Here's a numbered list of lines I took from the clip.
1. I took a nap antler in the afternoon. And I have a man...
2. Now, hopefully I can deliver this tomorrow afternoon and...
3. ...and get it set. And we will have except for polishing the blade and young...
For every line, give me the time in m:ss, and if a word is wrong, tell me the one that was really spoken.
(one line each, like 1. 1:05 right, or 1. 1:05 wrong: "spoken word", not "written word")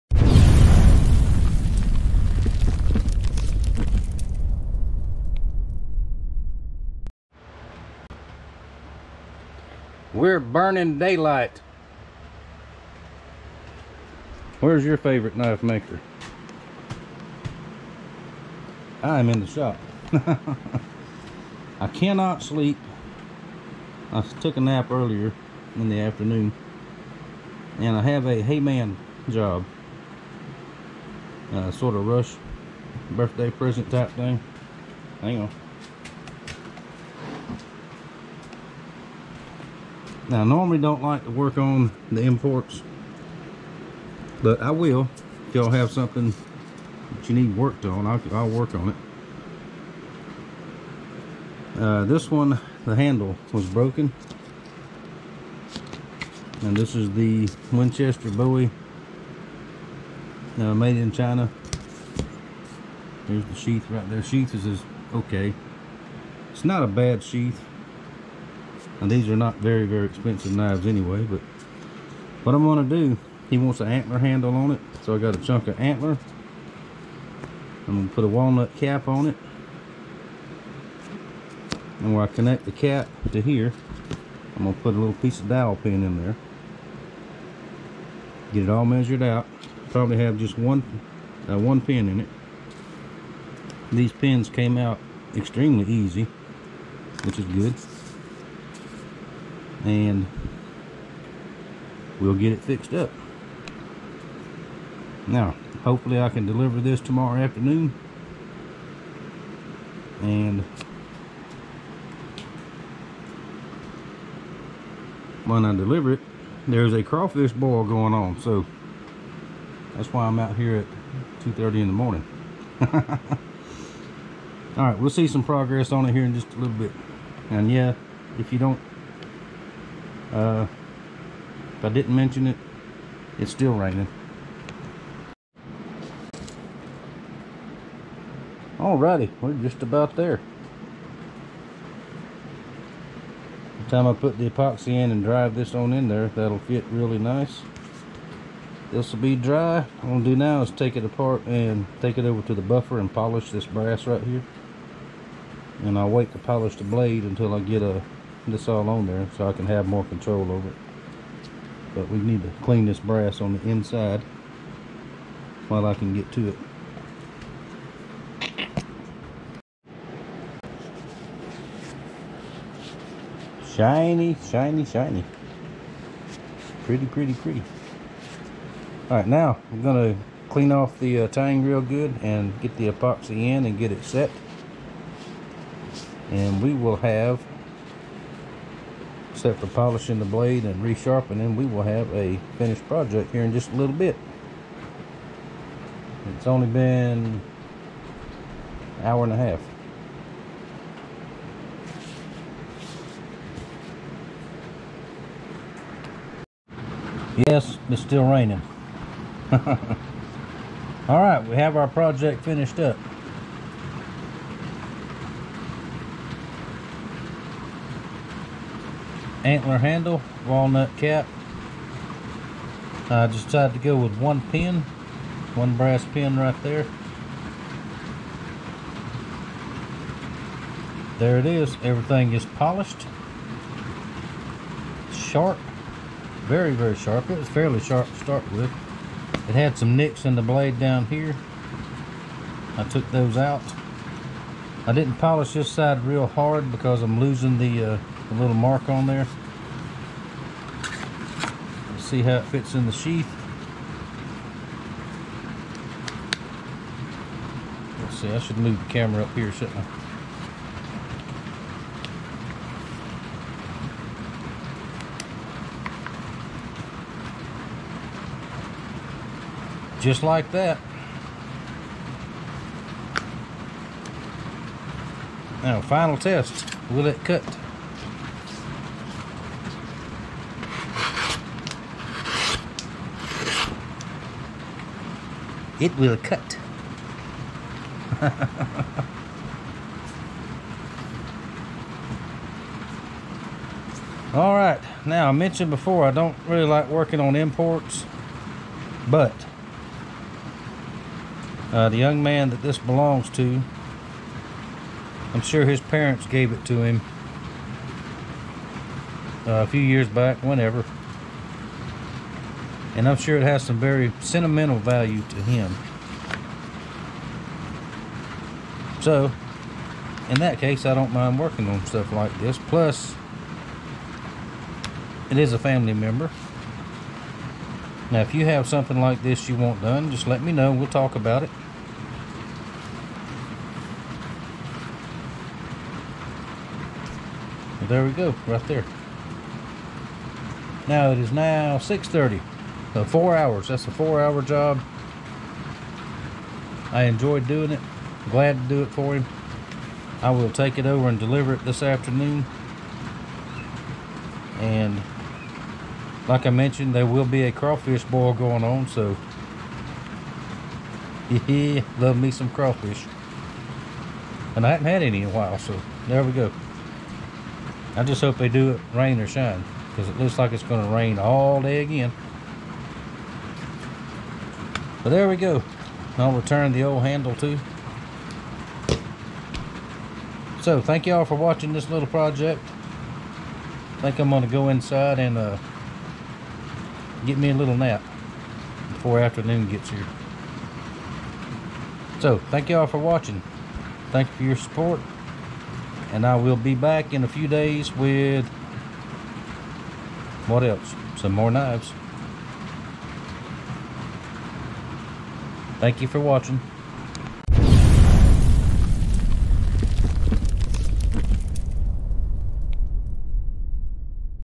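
1. 0:24 wrong: "earlier", not "antler"
2. 1:45 right
3. 3:03 wrong: "resharpening", not "young".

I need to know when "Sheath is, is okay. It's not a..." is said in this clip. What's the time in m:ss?
1:04.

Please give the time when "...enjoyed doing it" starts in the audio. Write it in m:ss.
5:47.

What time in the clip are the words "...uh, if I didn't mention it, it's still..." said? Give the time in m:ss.
2:10.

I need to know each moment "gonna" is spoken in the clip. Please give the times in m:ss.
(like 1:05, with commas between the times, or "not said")
1:12, 1:18, 1:24, 2:30, 2:59.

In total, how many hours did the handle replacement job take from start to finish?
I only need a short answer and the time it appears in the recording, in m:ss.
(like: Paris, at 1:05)
4 hours, at 5:43.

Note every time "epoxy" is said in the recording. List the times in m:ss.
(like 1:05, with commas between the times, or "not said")
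2:24, 3:02.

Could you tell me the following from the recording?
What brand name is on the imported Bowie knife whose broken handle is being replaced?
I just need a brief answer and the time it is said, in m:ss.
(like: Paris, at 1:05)
Winchester, at 0:57.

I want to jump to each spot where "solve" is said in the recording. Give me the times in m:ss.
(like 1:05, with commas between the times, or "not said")
not said.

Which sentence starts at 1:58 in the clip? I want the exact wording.
So that's why I'm out here at 2.30 in the morning.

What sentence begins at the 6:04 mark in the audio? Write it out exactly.
And I haven't had any in a while, so there we go.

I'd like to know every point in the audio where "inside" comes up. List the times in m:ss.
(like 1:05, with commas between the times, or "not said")
2:43, 6:24.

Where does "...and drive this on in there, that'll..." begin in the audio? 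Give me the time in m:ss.
2:25.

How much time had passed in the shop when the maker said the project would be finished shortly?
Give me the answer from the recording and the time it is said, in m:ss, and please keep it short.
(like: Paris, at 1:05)
An hour and a half, at 3:17.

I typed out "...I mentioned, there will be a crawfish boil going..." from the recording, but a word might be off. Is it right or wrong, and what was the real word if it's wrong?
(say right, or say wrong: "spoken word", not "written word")
right.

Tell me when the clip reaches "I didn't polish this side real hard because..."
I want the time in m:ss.
4:04.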